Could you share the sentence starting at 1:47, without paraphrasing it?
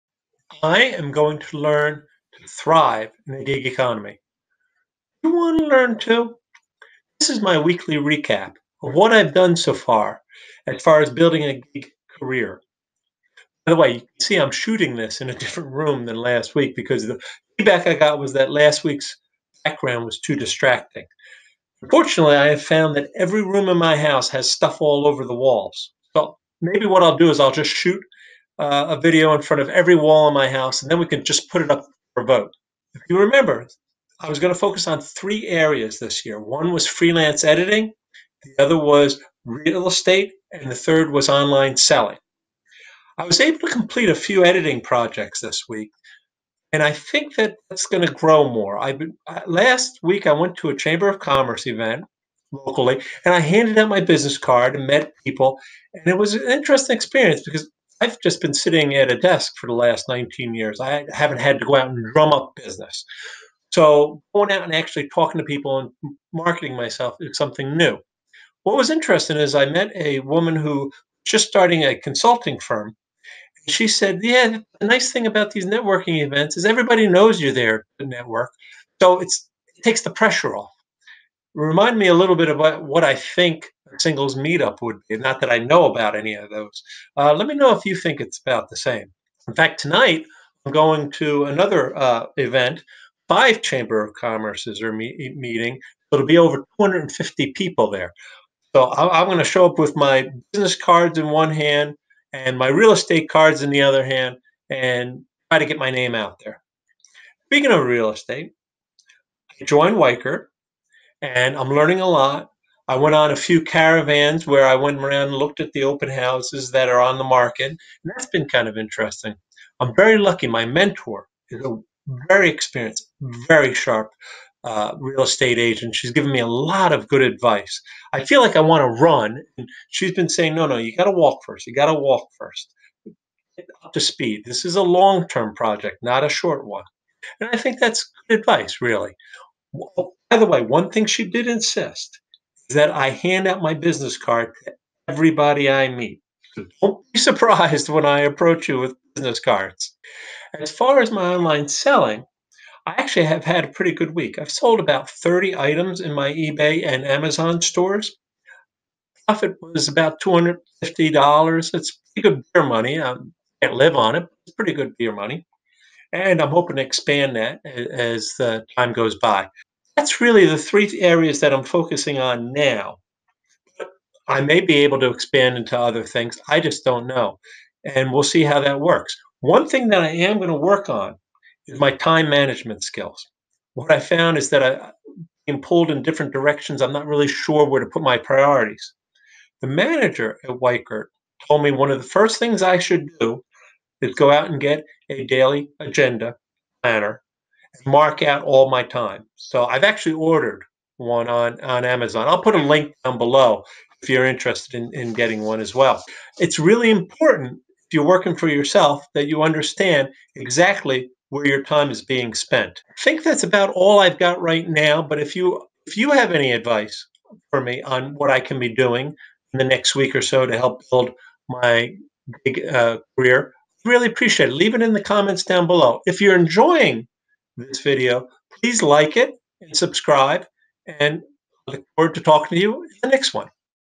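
Speaking of real estate, I joined Weichert and I'm learning a lot.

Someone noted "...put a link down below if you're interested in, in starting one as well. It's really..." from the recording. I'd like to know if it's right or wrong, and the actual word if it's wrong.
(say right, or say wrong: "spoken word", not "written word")
wrong: "getting", not "starting".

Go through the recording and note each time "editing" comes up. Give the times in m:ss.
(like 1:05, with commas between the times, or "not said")
0:37, 0:44.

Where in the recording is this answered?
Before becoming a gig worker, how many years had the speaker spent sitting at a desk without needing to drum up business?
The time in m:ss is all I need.
1:00.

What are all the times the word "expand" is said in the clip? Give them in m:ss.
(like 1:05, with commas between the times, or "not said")
2:46, 2:55.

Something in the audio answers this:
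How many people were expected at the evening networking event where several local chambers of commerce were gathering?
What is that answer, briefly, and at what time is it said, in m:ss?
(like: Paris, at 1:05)
250, at 1:36.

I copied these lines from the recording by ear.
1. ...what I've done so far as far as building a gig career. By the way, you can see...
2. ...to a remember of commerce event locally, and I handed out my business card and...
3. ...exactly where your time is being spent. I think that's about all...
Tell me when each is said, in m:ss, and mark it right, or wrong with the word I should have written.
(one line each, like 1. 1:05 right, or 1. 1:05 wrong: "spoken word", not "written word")
1. 0:08 right
2. 0:50 wrong: "chamber", not "remember"
3. 3:30 right.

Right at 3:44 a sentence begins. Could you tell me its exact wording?
Leave it in the comments down below.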